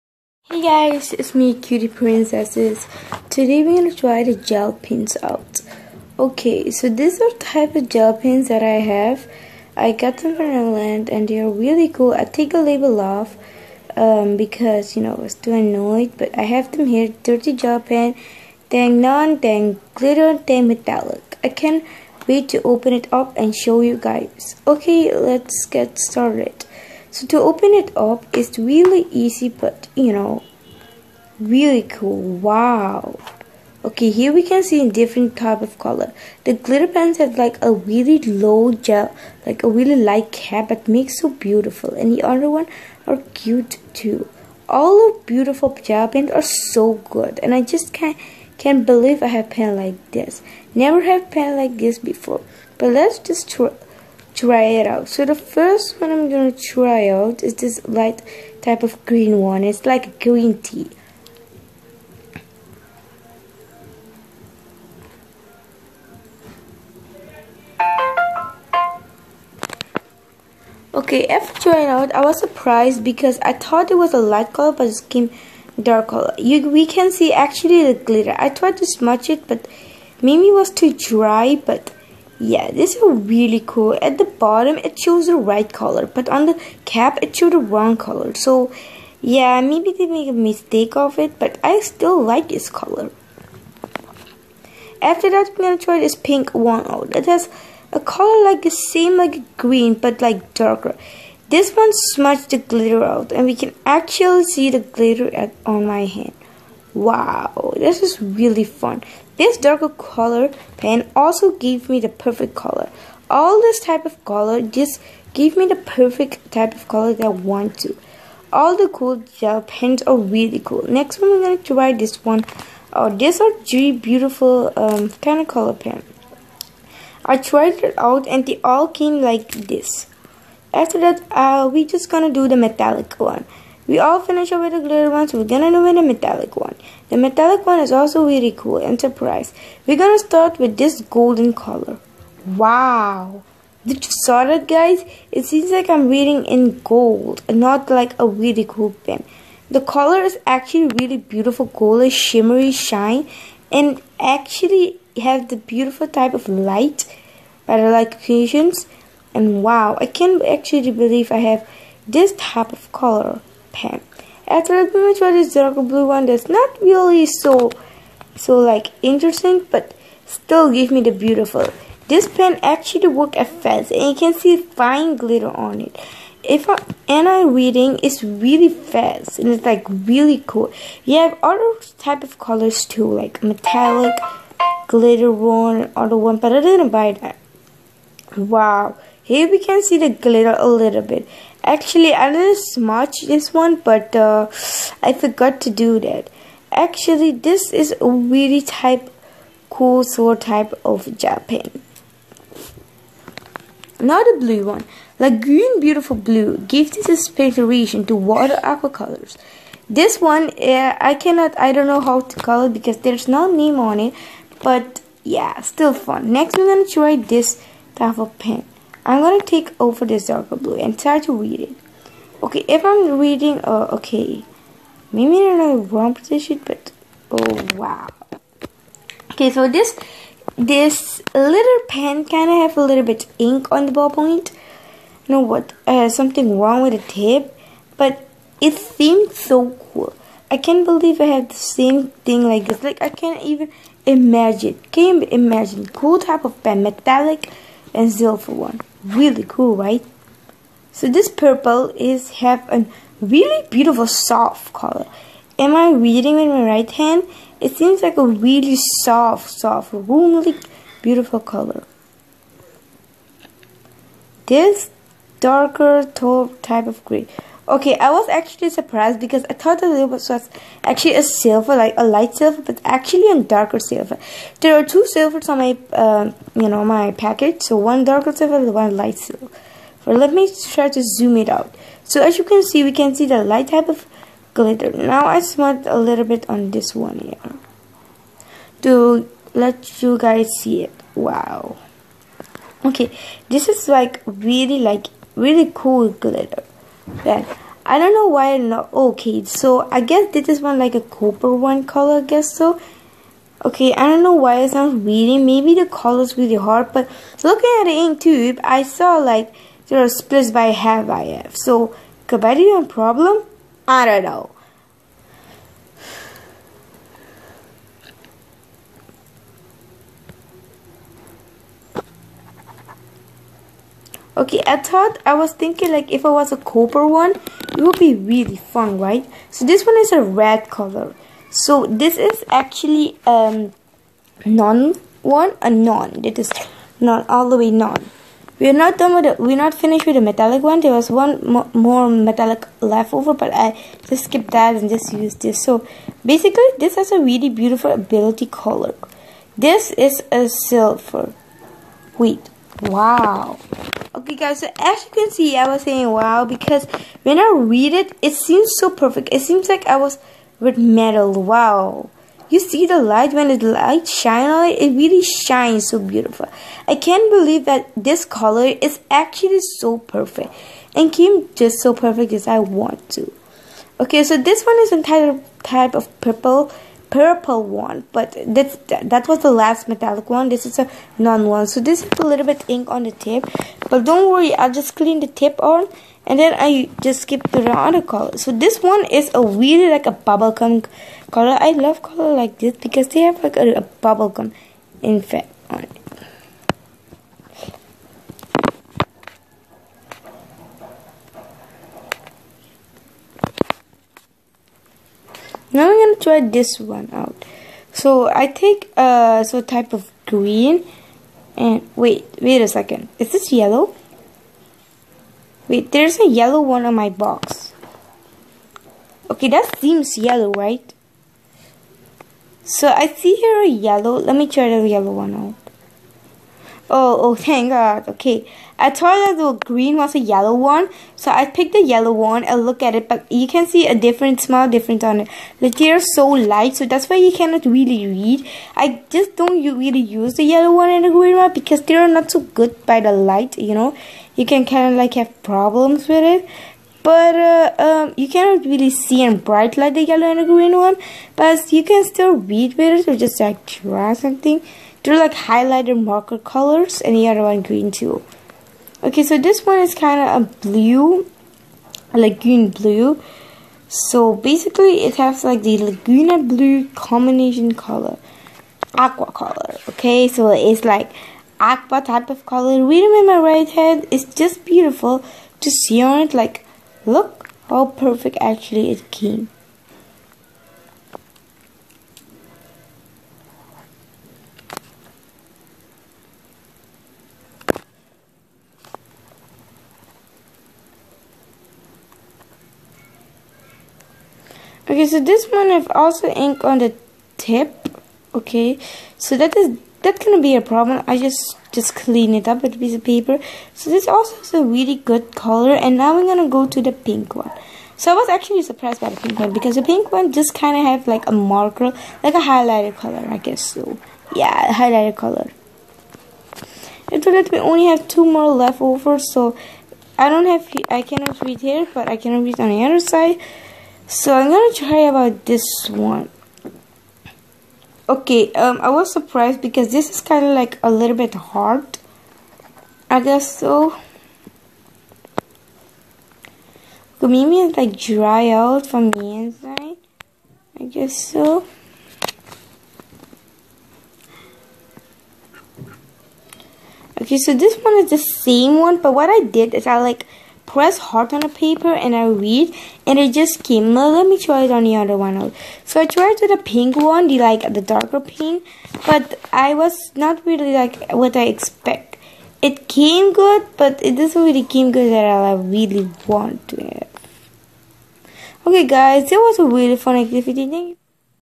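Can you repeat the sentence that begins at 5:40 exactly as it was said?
There was one mo more metallic left over, but I just skipped that and just used this.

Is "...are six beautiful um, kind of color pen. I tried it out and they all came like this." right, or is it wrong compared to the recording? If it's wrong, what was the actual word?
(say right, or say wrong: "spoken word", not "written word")
wrong: "three", not "six".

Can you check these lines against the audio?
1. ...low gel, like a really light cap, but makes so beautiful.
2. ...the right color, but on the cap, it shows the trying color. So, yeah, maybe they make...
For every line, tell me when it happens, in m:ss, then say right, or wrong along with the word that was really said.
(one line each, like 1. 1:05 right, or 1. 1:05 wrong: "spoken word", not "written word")
1. 0:38 right
2. 1:25 wrong: "wrong", not "trying".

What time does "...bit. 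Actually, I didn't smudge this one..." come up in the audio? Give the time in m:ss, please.
3:11.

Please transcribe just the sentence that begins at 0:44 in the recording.
All of beautiful gel pens are so good, and I just can't can't believe I have pen like this.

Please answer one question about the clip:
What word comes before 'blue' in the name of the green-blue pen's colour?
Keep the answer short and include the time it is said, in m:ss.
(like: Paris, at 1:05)
Laguna, at 7:45.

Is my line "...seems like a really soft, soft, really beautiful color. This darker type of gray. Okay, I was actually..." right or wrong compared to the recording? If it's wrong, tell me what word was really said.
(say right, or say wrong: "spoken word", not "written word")
right.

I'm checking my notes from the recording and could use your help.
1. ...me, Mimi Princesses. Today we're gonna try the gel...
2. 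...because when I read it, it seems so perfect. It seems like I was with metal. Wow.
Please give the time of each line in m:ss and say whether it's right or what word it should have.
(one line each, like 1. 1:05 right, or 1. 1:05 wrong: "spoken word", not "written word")
1. 0:01 wrong: "Cutie", not "Mimi"
2. 5:56 right.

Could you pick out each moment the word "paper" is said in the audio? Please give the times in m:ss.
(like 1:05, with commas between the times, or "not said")
8:23, 9:11.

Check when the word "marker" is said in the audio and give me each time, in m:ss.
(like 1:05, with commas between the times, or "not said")
7:36, 8:31.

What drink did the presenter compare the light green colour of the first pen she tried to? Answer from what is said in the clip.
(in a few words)
Green tea.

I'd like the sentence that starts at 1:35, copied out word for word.
After that, we gonna try this pink one out.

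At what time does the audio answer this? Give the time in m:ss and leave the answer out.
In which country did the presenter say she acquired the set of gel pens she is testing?
0:10.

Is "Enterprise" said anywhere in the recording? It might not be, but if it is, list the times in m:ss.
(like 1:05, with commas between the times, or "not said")
2:18.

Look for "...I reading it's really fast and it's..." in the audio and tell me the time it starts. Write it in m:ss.
2:57.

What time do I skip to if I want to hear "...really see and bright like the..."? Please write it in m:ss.
7:28.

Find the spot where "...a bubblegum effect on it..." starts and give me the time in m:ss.
6:33.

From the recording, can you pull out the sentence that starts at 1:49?
This darker color pen also gave me the perfect color.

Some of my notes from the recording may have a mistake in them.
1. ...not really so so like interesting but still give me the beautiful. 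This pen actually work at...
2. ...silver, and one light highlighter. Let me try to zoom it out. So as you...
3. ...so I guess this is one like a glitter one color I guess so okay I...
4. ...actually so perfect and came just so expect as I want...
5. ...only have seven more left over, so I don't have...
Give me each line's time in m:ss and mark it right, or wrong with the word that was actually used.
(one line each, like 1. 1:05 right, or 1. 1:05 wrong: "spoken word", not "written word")
1. 2:46 right
2. 4:38 wrong: "silver", not "highlighter"
3. 4:59 wrong: "copper", not "glitter"
4. 6:09 wrong: "perfect", not "expect"
5. 8:37 wrong: "two", not "seven".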